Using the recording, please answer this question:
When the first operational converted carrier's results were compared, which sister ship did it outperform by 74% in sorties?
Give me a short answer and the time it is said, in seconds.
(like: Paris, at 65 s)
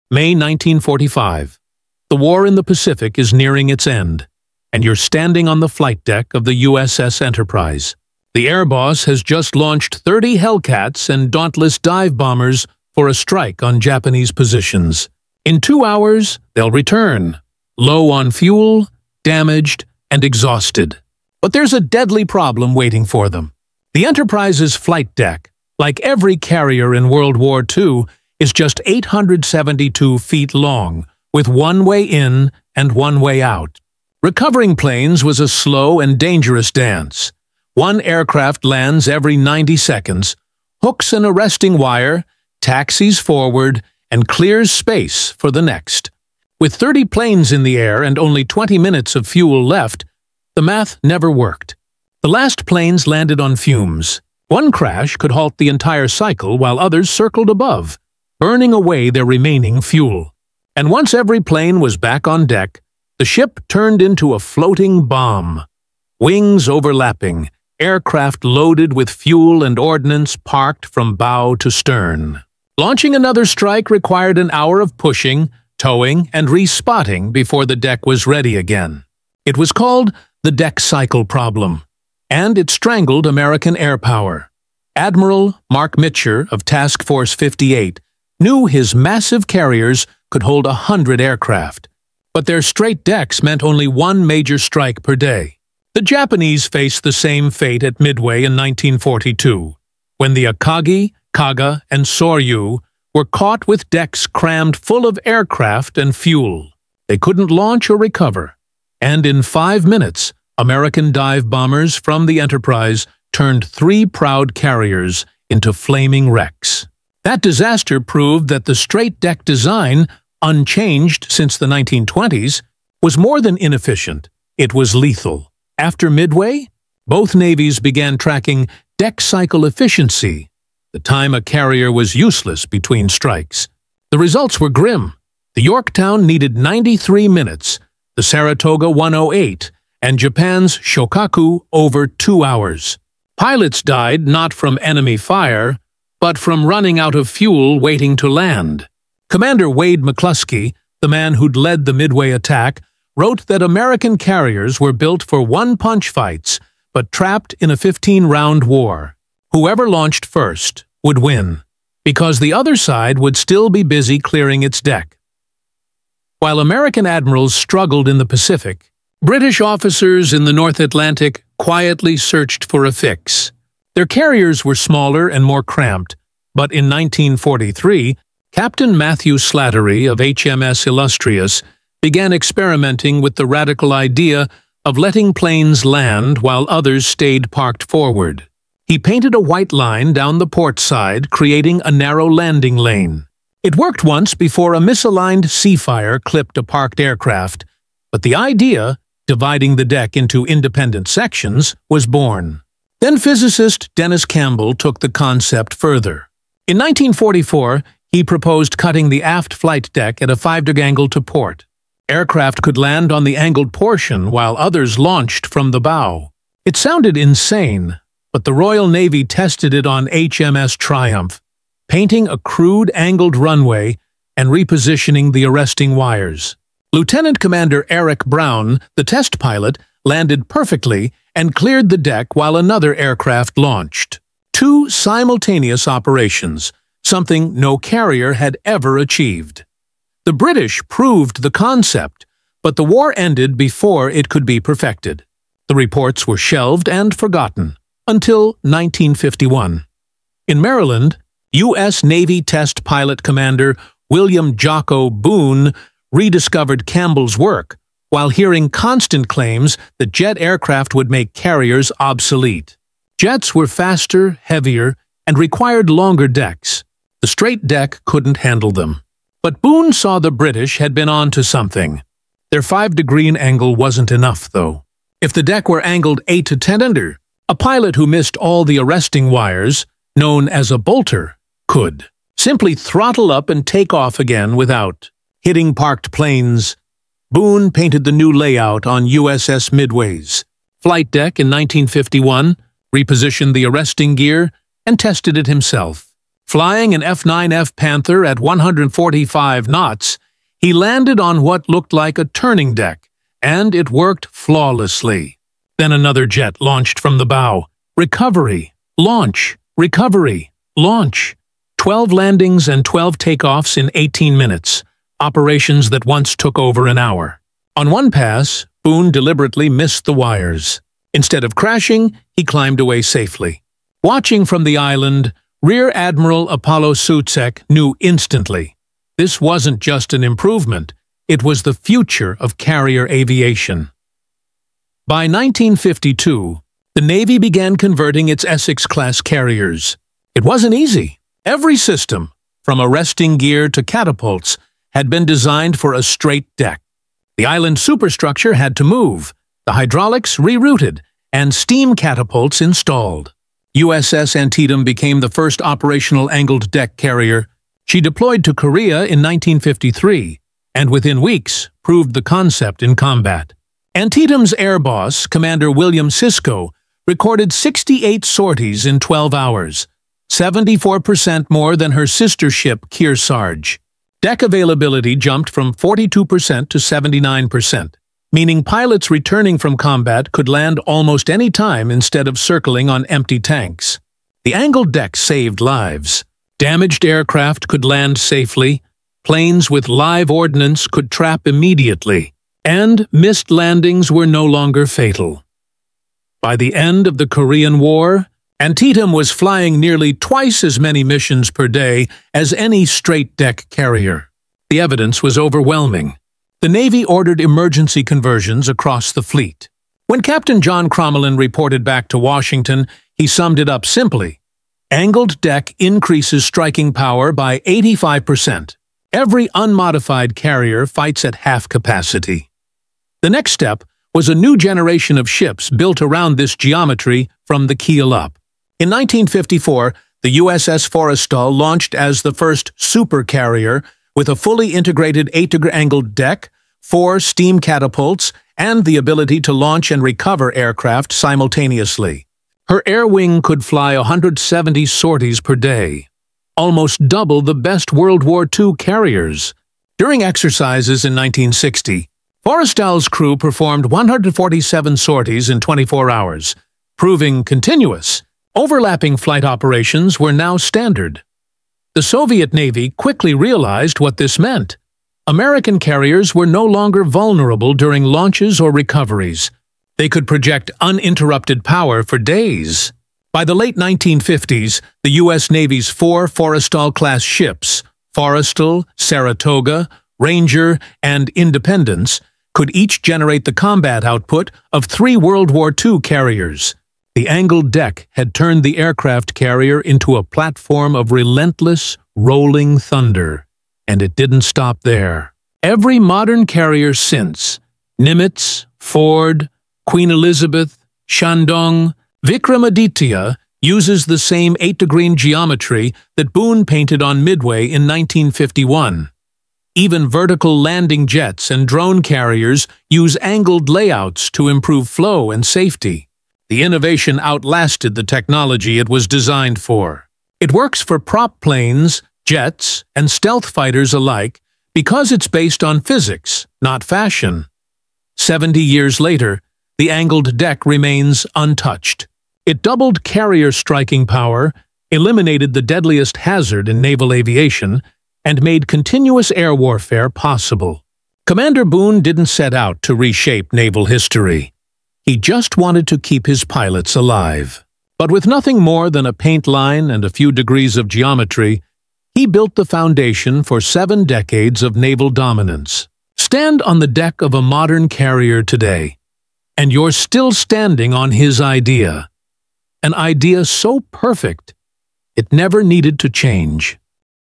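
Kearsarge, at 372 s.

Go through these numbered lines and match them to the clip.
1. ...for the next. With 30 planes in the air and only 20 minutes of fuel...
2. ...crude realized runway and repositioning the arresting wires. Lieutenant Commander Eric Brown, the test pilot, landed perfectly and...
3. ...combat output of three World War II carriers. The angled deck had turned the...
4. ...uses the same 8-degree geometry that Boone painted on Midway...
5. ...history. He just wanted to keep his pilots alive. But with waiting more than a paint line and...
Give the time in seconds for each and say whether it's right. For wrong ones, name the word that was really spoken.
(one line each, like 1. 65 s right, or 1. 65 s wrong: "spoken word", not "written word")
1. 45 s right
2. 222 s wrong: "angled", not "realized"
3. 483 s right
4. 503 s right
5. 543 s wrong: "nothing", not "waiting".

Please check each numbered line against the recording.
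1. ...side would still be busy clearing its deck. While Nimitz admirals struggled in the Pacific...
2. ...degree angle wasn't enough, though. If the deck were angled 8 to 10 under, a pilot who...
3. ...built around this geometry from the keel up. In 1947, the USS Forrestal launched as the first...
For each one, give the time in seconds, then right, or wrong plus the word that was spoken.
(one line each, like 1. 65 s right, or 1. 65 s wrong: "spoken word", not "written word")
1. 162 s wrong: "American", not "Nimitz"
2. 272 s right
3. 425 s wrong: "1954", not "1947".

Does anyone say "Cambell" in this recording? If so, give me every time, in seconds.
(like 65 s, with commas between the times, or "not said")
204 s, 256 s.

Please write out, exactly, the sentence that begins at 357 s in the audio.
She deployed to Korea in 1953 and within weeks proved the concept in combat.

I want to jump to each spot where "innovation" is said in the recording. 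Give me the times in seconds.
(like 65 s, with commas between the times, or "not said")
516 s.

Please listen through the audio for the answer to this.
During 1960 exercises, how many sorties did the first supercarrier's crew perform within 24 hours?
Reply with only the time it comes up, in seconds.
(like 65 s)
453 s.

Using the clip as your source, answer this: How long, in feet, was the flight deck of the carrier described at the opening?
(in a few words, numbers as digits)
872 feet.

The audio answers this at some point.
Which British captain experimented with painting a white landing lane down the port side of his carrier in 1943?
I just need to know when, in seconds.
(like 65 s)
178 s.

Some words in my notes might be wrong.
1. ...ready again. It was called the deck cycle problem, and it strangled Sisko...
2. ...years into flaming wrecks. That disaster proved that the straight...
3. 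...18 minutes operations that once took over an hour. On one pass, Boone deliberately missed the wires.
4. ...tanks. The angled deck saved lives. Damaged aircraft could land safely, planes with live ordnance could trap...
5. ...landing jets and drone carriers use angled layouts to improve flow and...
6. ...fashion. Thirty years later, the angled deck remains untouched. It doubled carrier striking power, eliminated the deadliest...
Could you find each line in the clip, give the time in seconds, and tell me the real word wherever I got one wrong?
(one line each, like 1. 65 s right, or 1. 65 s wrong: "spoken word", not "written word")
1. 78 s wrong: "American", not "Sisko"
2. 114 s wrong: "carriers", not "years"
3. 313 s right
4. 383 s right
5. 510 s right
6. 526 s wrong: "Seventy", not "Thirty".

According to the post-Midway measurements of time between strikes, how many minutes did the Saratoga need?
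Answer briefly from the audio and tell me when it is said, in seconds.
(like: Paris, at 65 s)
108, at 138 s.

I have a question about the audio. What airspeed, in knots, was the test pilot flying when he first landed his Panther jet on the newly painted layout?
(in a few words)
145 knots.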